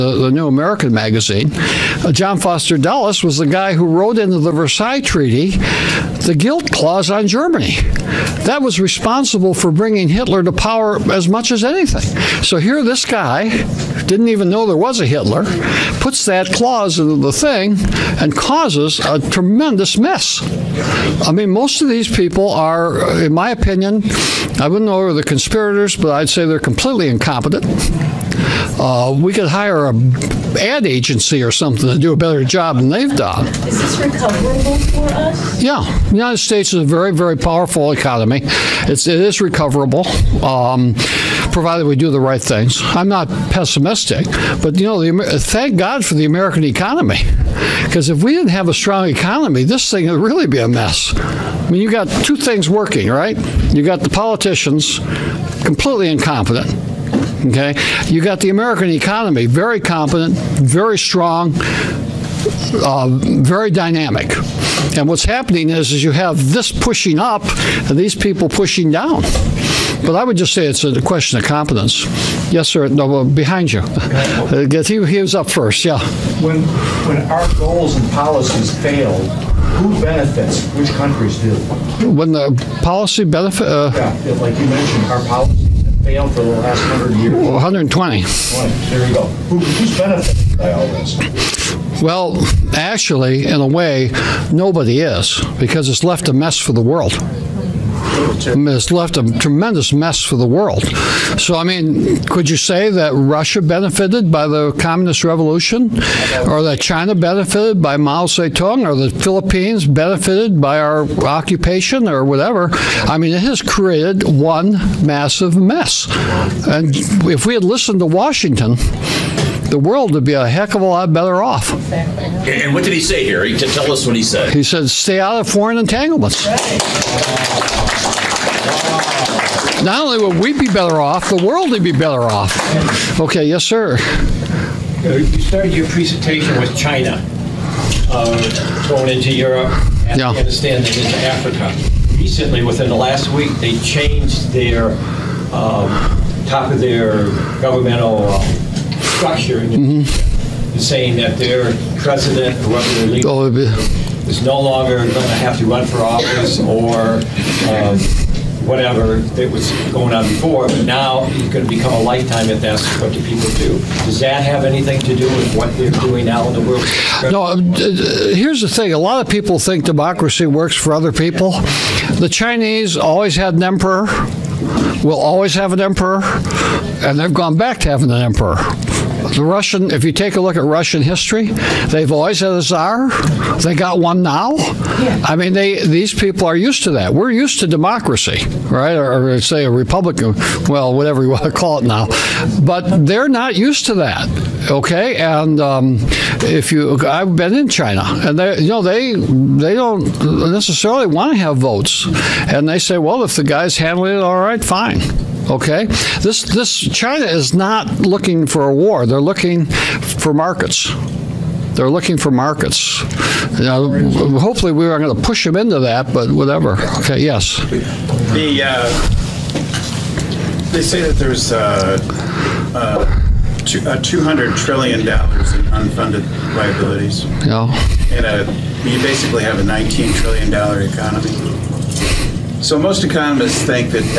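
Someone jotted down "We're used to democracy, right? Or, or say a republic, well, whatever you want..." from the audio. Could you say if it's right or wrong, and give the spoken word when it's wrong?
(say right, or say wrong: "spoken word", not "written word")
right.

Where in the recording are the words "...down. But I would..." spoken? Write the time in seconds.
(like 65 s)
68 s.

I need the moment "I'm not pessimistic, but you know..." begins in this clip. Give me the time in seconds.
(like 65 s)
42 s.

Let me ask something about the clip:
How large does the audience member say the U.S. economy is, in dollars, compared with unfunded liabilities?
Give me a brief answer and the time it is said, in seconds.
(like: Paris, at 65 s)
$19 trillion, at 229 s.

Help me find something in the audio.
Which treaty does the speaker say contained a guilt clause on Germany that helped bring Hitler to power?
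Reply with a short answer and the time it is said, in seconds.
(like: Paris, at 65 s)
Versailles Treaty, at 4 s.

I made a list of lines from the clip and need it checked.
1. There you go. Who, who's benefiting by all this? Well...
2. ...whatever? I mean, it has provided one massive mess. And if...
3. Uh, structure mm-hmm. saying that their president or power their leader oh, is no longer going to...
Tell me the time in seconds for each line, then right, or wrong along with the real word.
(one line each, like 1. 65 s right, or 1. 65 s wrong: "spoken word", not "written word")
1. 88 s right
2. 112 s wrong: "created", not "provided"
3. 148 s wrong: "whoever", not "power".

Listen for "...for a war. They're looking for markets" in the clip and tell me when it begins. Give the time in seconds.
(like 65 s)
208 s.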